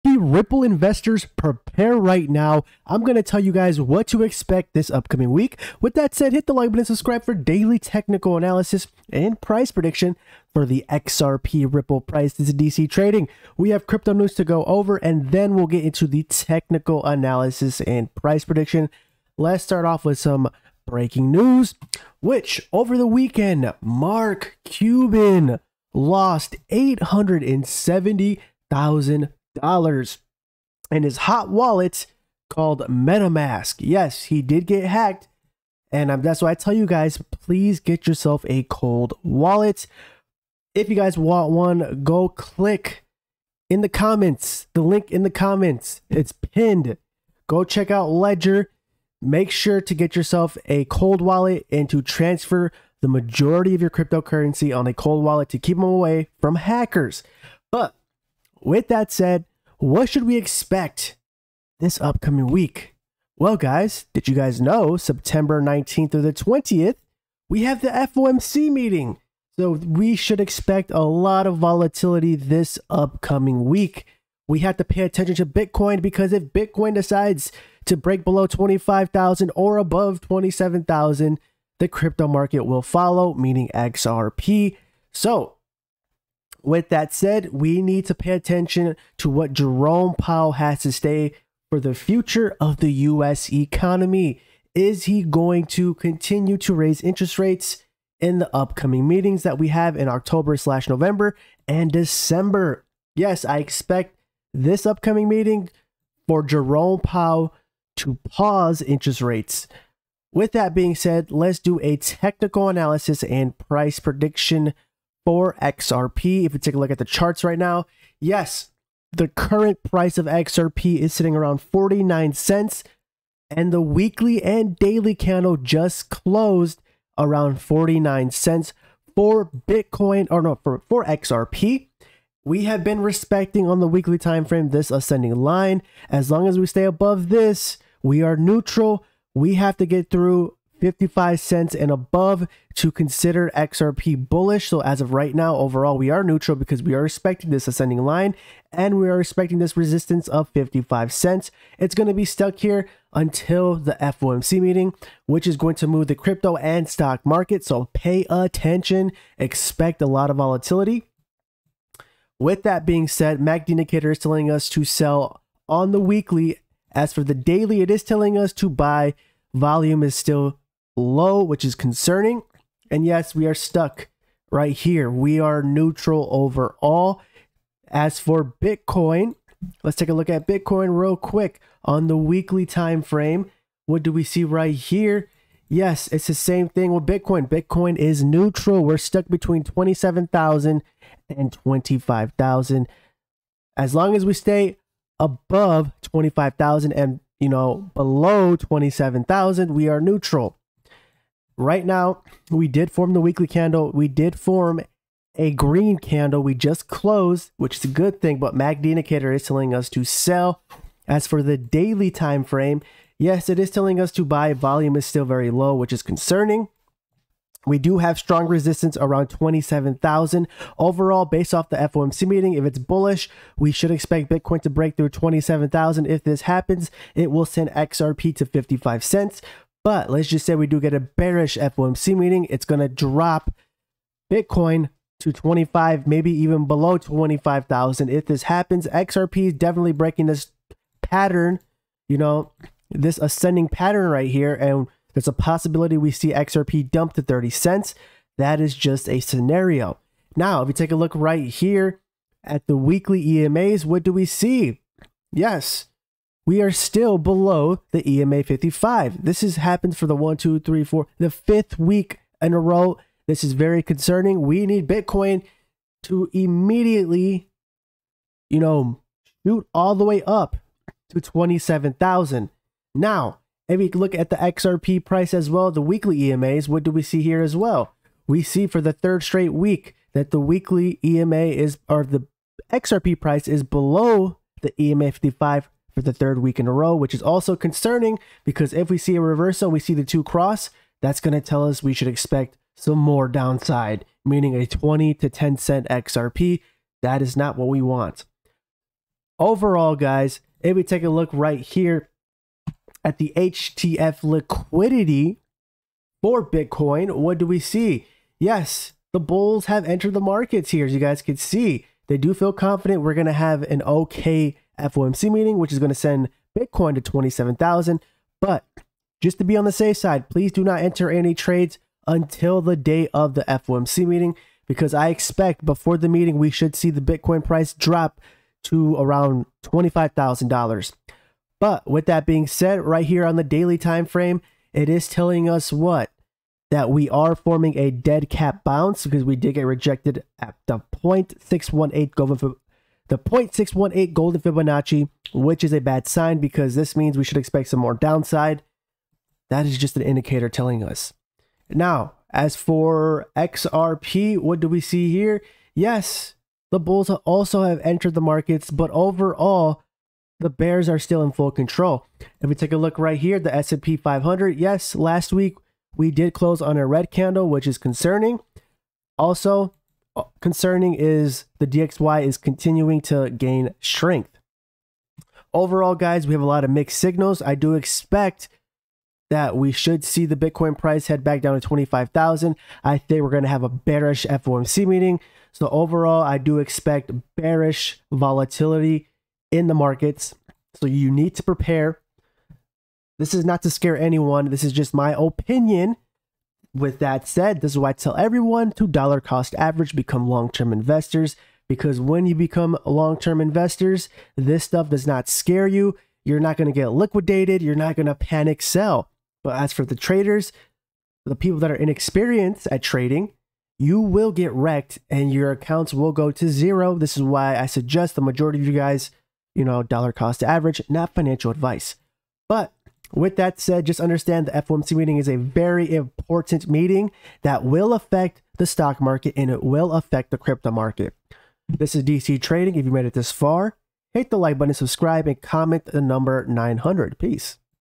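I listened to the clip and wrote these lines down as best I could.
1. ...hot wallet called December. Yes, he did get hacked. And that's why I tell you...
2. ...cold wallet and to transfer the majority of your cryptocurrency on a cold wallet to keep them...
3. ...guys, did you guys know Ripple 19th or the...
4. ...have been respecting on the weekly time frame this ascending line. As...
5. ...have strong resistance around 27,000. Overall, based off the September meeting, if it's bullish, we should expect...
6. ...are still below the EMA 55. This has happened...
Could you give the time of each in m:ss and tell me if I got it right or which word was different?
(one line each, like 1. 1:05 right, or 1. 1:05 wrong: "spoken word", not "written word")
1. 0:31 wrong: "MetaMask", not "December"
2. 0:50 right
3. 1:03 wrong: "September", not "Ripple"
4. 2:12 right
5. 3:37 wrong: "FOMC", not "September"
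6. 4:16 right.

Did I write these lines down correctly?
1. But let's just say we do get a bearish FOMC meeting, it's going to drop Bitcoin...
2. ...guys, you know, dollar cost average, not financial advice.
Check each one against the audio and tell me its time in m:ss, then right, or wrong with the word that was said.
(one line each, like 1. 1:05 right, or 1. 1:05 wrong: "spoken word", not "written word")
1. 3:49 right
2. 6:58 right.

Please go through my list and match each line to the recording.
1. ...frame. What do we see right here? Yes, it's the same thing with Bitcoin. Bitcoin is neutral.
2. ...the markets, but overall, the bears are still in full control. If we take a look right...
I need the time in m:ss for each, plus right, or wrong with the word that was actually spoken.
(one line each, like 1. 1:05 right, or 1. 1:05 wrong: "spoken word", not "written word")
1. 3:03 right
2. 5:58 right.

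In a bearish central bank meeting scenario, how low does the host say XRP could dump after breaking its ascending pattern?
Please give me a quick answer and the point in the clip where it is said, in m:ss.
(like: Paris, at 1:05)
30 cents, at 4:07.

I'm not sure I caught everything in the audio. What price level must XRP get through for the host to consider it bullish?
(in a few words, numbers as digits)
55 cents.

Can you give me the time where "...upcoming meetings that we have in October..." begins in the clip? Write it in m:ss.
1:38.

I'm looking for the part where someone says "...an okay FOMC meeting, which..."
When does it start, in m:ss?
5:13.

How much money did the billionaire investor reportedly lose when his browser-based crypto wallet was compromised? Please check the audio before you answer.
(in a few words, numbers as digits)
$870,000.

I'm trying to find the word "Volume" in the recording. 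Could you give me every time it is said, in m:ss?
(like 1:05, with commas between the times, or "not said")
2:49, 3:34.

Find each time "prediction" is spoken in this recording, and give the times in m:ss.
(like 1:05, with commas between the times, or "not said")
0:09, 0:18, 1:53.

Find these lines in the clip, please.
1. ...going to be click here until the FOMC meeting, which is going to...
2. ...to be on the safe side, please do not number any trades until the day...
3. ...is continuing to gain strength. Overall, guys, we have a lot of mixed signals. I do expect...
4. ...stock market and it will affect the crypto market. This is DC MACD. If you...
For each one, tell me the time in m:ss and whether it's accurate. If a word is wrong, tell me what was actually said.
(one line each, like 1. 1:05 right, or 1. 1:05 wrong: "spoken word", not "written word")
1. 2:31 wrong: "stuck", not "click"
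2. 5:19 wrong: "enter", not "number"
3. 6:12 right
4. 7:08 wrong: "Trading", not "MACD".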